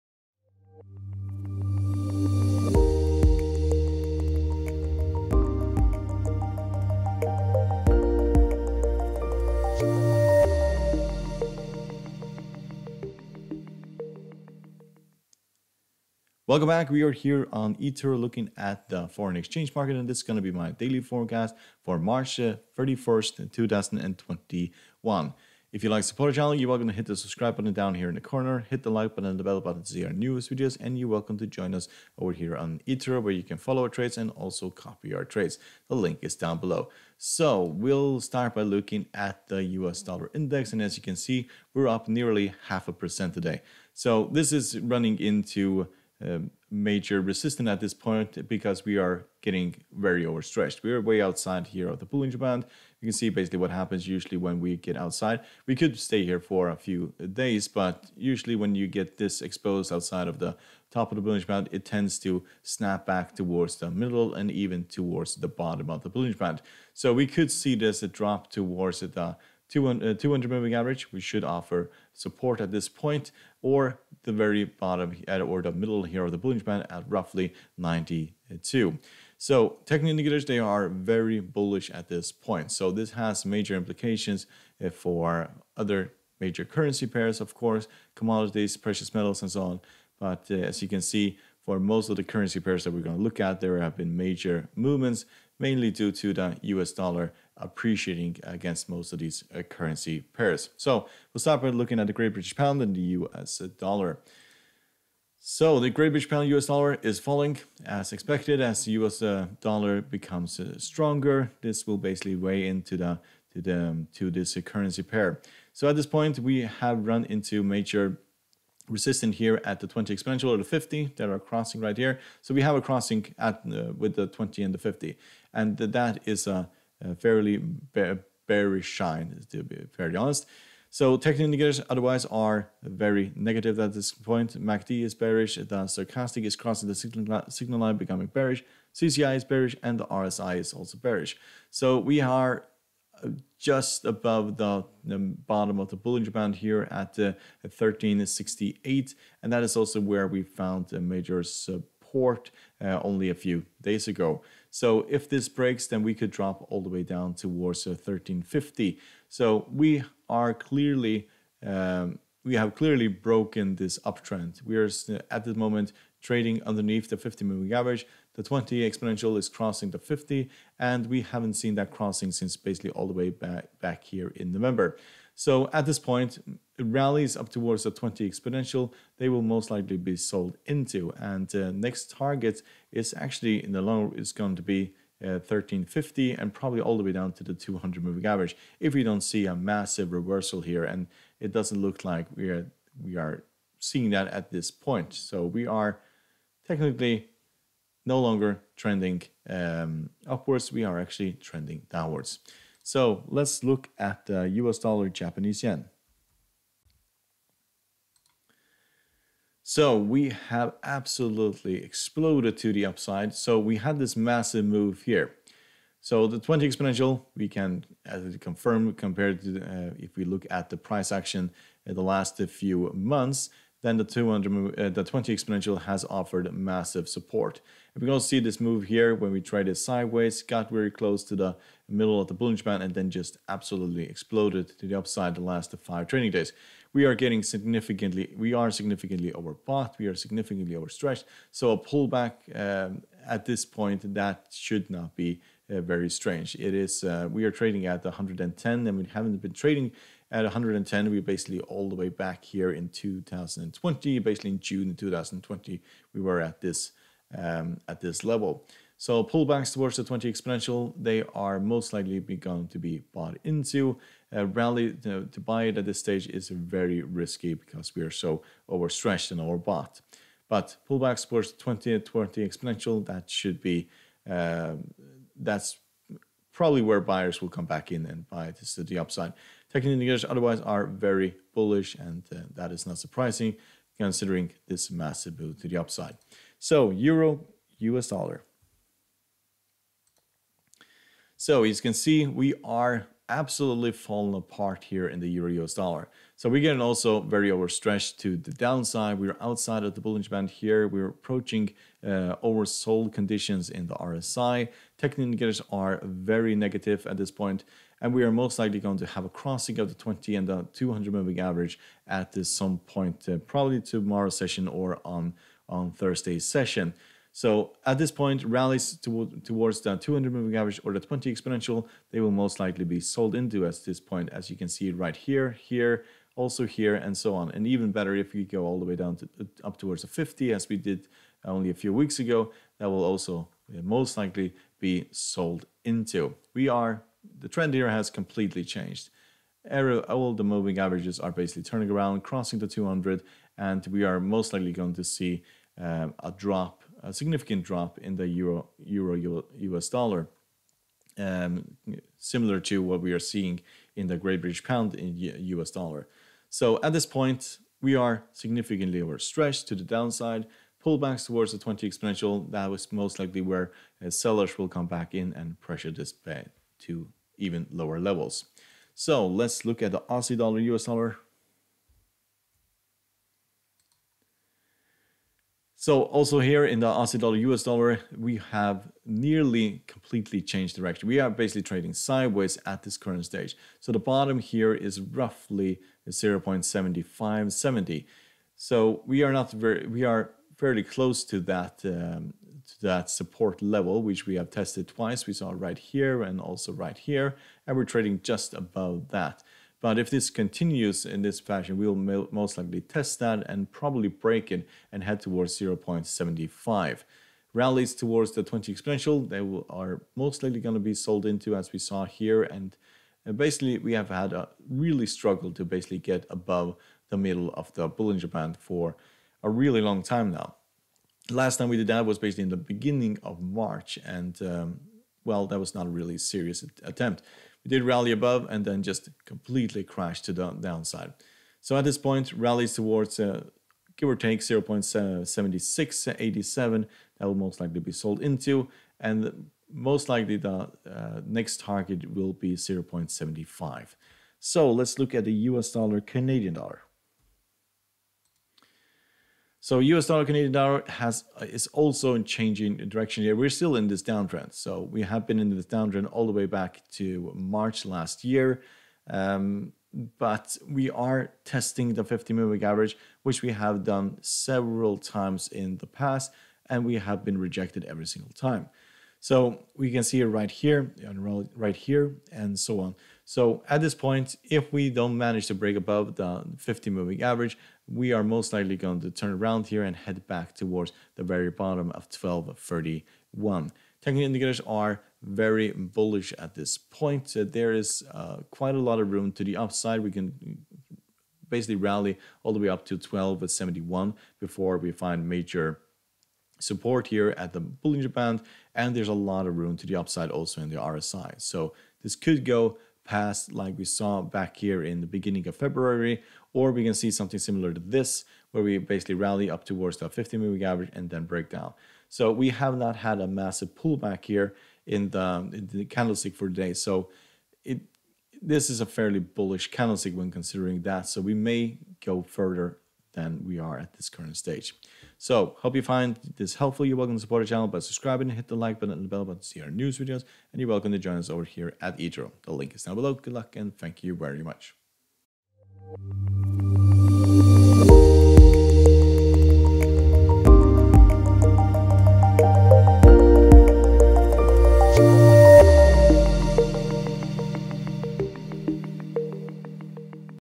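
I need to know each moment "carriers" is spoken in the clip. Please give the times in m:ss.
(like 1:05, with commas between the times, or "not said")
not said.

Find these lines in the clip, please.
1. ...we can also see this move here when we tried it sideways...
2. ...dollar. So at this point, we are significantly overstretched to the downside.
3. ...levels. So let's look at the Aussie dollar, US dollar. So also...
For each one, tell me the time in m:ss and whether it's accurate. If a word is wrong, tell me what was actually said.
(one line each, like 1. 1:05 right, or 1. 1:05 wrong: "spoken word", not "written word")
1. 3:48 right
2. 5:55 right
3. 6:07 right.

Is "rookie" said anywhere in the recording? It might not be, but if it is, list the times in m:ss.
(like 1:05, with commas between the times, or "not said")
not said.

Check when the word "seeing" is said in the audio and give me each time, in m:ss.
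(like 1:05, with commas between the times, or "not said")
3:13, 5:53.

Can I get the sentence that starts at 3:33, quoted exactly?
So we had this massive move here.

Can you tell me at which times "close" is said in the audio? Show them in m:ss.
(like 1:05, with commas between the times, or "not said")
3:50, 6:30.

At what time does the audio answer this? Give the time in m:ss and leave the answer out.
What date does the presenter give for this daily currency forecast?
0:21.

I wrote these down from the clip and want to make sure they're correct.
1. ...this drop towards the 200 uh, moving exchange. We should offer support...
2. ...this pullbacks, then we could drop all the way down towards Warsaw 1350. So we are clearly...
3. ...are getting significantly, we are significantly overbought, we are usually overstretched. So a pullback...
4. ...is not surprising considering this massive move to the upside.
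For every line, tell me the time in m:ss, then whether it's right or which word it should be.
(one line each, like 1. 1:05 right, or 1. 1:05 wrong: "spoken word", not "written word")
1. 1:07 wrong: "average", not "exchange"
2. 2:35 wrong: "breaks", not "pullbacks"
3. 3:57 wrong: "significantly", not "usually"
4. 4:42 right.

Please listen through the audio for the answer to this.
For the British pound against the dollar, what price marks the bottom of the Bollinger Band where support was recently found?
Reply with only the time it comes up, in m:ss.
2:27.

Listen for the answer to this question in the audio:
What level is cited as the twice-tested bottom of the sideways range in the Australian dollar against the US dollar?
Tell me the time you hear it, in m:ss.
6:26.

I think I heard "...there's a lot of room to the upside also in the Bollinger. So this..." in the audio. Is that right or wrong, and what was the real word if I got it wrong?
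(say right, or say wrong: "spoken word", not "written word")
wrong: "RSI", not "Bollinger".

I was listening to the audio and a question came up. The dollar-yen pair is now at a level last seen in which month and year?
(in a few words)
June 2020.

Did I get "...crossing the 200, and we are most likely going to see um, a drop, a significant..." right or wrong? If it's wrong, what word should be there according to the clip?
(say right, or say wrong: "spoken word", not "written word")
right.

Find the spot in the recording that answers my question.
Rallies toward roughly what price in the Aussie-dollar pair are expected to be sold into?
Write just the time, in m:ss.
7:14.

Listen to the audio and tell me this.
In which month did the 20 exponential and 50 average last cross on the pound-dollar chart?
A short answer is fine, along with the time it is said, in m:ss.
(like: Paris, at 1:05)
November, at 2:54.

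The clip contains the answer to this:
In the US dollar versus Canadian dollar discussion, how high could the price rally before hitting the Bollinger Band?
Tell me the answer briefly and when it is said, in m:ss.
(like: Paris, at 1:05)
1.271, at 8:12.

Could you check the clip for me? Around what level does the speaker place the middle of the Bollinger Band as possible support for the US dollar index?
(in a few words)
92.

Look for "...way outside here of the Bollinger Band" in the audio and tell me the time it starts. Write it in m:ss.
0:51.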